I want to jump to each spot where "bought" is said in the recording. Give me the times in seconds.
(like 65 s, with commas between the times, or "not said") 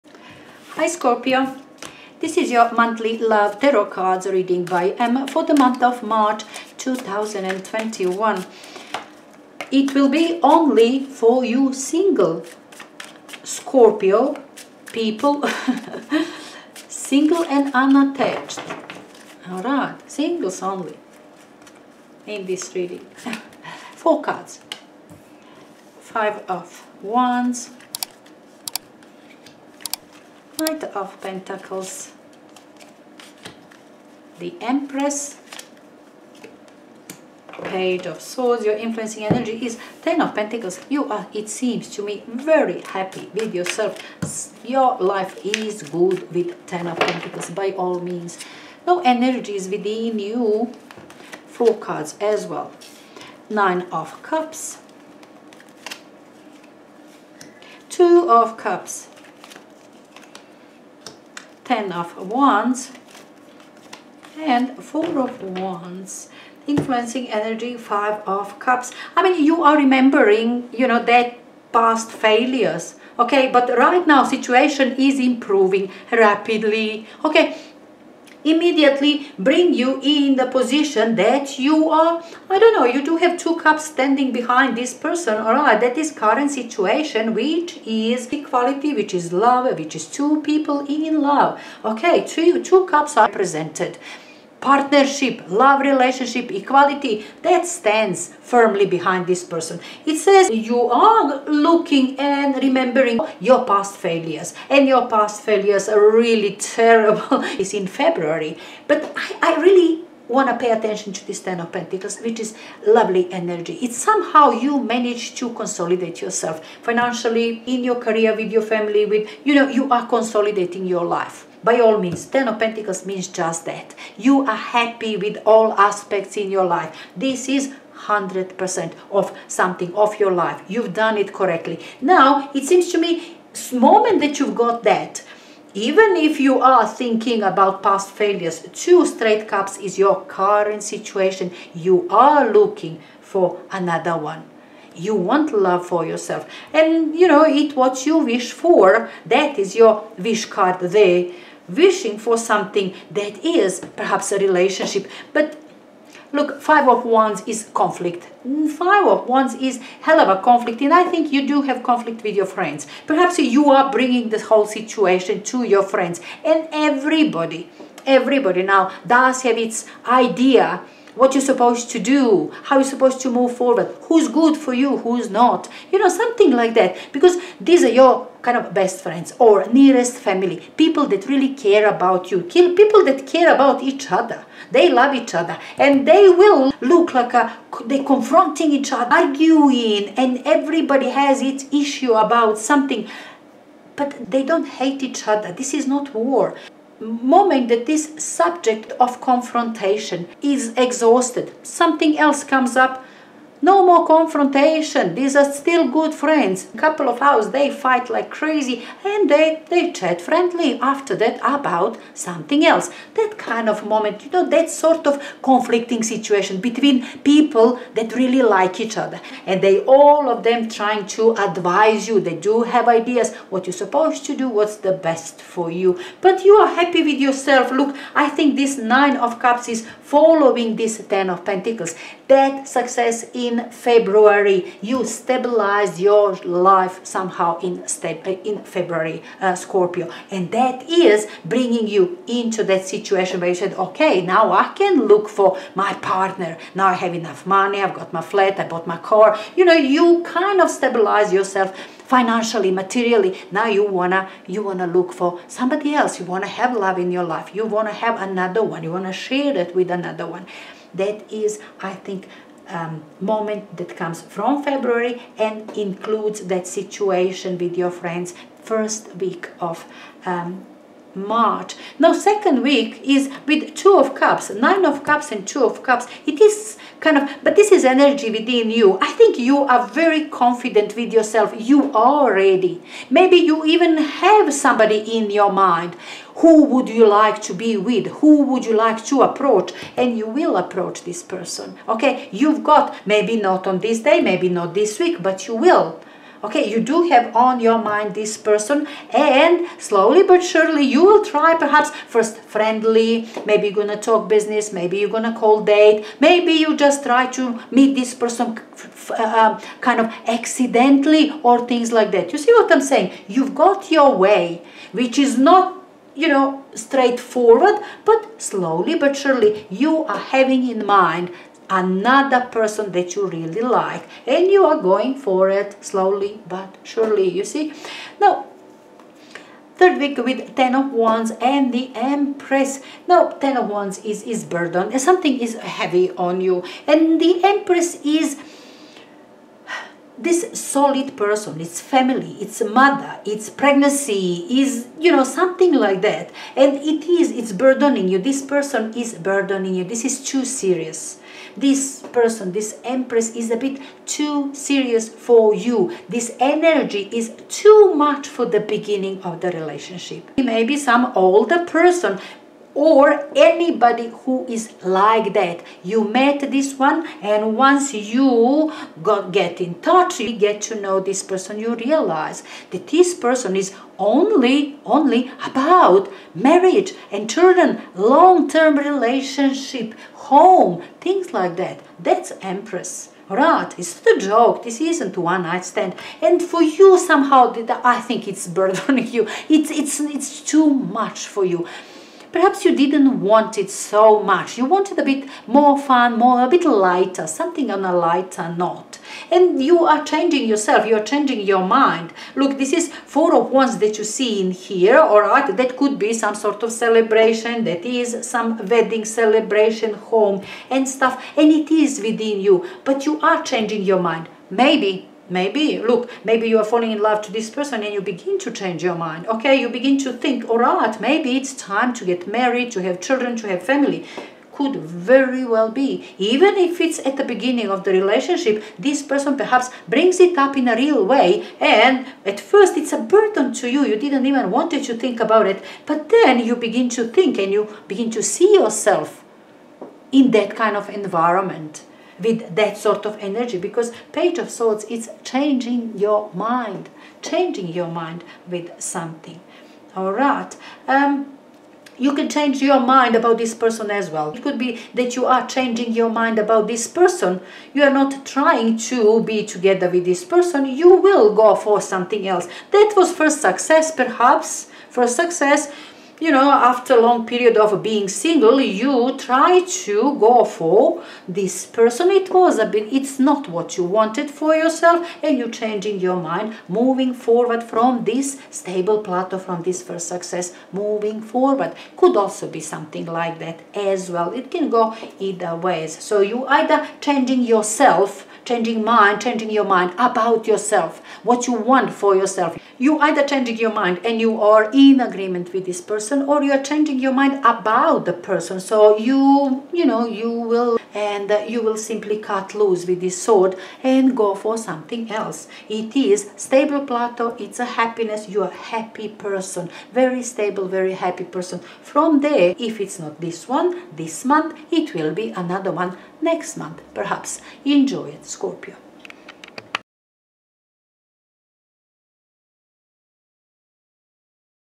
248 s.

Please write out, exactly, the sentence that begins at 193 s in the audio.
But they don't hate each other.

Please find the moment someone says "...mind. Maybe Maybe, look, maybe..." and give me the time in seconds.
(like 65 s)
413 s.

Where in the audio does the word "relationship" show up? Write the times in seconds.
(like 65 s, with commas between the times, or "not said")
95 s, 154 s, 359 s, 378 s, 427 s.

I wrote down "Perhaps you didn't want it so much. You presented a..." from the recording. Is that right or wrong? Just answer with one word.
wrong.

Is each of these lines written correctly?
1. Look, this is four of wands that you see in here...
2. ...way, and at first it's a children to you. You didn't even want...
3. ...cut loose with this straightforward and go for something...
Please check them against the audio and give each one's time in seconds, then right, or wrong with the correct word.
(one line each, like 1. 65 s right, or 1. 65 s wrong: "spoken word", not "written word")
1. 402 s right
2. 431 s wrong: "burden", not "children"
3. 502 s wrong: "sword", not "straightforward".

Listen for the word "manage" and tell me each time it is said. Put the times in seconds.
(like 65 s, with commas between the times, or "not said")
114 s.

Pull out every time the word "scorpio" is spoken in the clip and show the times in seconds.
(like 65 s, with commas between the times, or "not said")
0 s, 13 s, 239 s, 518 s.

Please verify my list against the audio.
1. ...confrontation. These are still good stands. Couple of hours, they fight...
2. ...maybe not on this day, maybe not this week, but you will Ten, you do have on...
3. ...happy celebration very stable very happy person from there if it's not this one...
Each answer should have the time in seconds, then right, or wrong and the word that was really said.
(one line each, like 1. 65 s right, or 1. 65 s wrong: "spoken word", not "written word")
1. 204 s wrong: "friends", not "stands"
2. 293 s wrong: "Okay", not "Ten"
3. 508 s wrong: "person", not "celebration".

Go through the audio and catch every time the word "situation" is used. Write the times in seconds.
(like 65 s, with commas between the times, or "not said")
74 s, 86 s, 140 s, 164 s, 216 s, 242 s, 266 s.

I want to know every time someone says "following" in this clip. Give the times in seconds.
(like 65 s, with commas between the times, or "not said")
230 s.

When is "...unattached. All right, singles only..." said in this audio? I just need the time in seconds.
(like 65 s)
17 s.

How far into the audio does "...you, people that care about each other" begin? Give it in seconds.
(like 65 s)
182 s.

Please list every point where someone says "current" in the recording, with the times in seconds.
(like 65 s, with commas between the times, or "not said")
86 s, 140 s.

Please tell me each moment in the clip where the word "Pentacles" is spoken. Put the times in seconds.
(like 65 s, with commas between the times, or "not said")
31 s, 40 s, 46 s, 111 s, 122 s, 231 s.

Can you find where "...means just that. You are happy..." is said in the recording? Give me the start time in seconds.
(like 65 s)
123 s.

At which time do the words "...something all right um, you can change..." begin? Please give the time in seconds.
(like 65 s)
448 s.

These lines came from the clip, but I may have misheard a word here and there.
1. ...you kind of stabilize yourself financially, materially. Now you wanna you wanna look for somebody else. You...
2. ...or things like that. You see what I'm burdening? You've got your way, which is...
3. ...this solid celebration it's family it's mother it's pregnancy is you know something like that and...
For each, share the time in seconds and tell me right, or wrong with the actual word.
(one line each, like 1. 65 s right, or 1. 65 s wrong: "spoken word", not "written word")
1. 249 s right
2. 311 s wrong: "saying", not "burdening"
3. 340 s wrong: "person", not "celebration".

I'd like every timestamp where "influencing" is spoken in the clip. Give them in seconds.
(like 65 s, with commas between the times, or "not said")
38 s, 66 s.